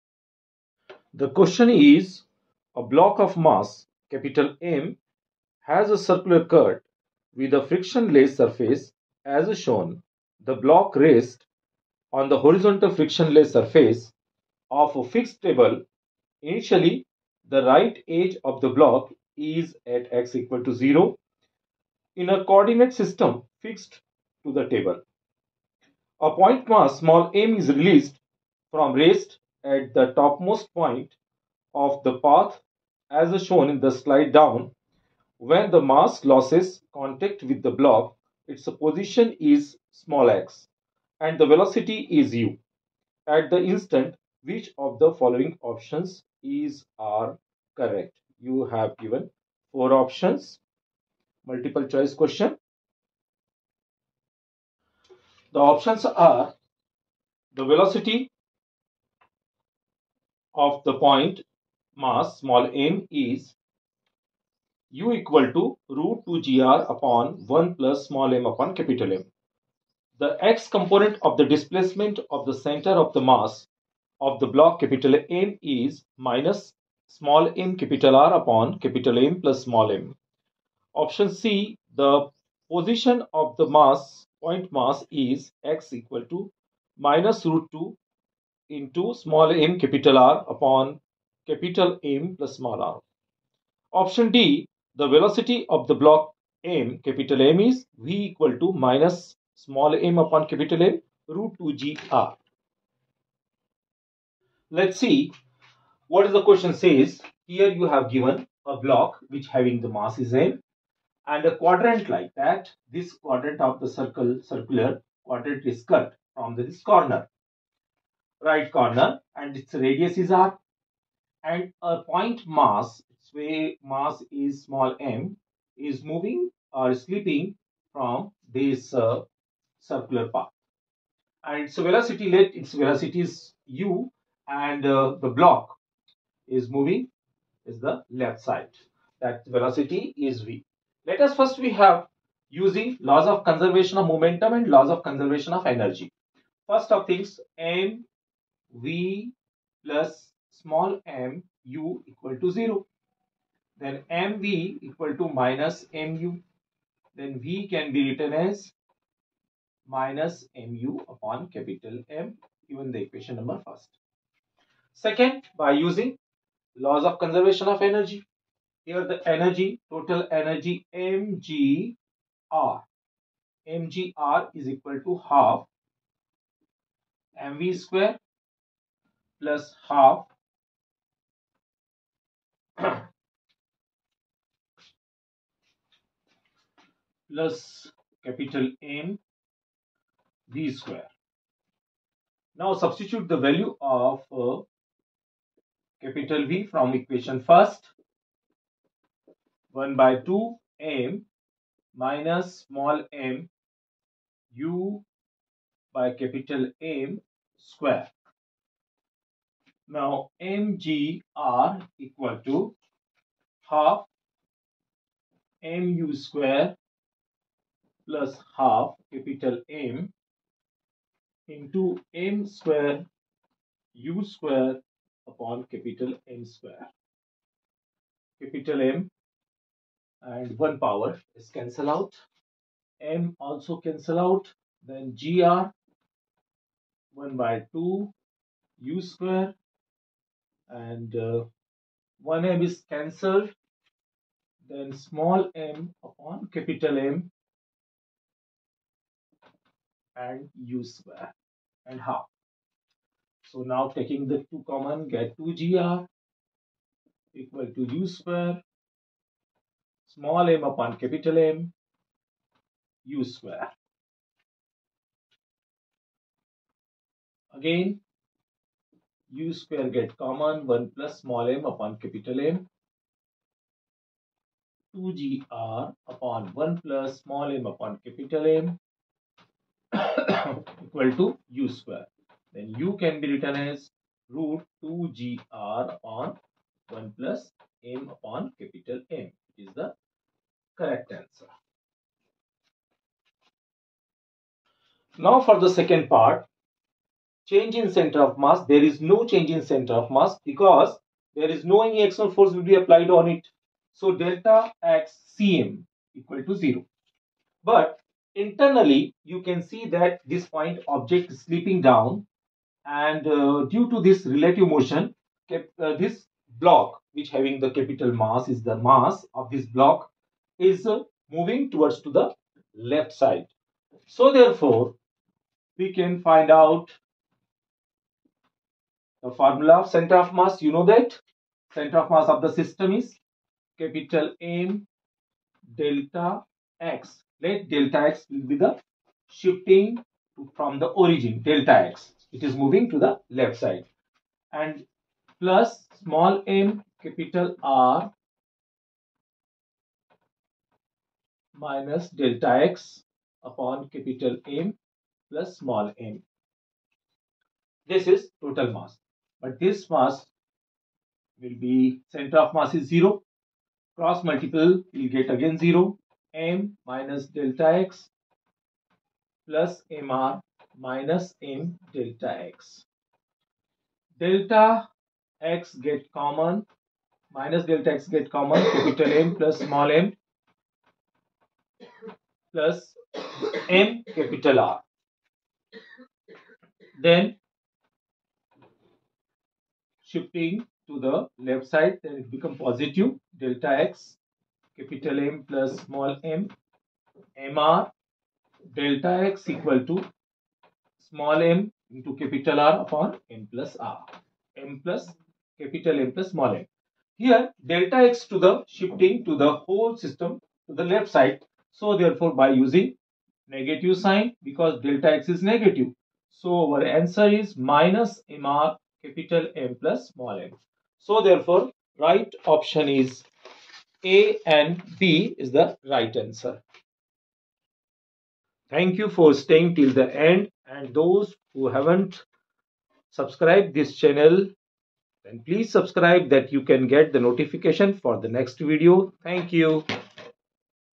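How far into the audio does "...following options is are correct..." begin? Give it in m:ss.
0:45.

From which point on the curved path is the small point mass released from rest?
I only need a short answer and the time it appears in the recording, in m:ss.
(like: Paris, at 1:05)
the topmost point, at 0:30.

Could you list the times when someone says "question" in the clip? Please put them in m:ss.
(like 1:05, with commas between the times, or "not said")
0:01, 0:52, 1:46.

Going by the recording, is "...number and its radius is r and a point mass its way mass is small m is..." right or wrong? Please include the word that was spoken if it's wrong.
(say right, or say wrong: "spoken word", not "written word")
wrong: "corner", not "number".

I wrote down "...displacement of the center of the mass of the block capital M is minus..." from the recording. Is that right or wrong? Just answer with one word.
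right.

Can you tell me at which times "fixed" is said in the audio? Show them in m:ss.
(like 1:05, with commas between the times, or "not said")
0:15, 0:23.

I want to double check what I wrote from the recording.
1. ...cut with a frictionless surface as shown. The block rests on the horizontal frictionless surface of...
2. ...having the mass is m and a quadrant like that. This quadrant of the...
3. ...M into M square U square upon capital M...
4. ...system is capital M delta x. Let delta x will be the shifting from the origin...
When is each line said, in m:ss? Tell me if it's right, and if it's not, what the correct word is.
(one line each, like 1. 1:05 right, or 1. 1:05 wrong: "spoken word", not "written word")
1. 0:06 right
2. 1:49 right
3. 3:39 right
4. 5:32 right.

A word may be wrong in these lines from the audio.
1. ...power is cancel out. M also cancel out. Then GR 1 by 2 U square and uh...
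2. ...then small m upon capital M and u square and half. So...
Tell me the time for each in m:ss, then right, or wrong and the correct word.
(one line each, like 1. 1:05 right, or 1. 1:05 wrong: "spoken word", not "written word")
1. 3:50 right
2. 4:04 right.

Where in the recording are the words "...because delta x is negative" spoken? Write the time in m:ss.
6:54.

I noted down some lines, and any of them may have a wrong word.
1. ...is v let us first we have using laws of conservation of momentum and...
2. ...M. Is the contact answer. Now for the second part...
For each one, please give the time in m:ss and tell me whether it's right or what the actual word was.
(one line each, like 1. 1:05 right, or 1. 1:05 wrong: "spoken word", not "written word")
1. 2:20 right
2. 4:49 wrong: "correct", not "contact".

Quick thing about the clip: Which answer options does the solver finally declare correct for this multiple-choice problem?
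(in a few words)
A and B.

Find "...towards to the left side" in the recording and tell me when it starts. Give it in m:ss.
5:21.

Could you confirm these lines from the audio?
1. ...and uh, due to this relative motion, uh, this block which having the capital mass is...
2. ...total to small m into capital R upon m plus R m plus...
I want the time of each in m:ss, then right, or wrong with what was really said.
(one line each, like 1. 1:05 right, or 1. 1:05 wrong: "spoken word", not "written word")
1. 5:12 right
2. 6:39 wrong: "equal", not "total".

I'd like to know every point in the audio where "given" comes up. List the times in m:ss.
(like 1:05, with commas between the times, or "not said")
0:48, 1:48, 2:42.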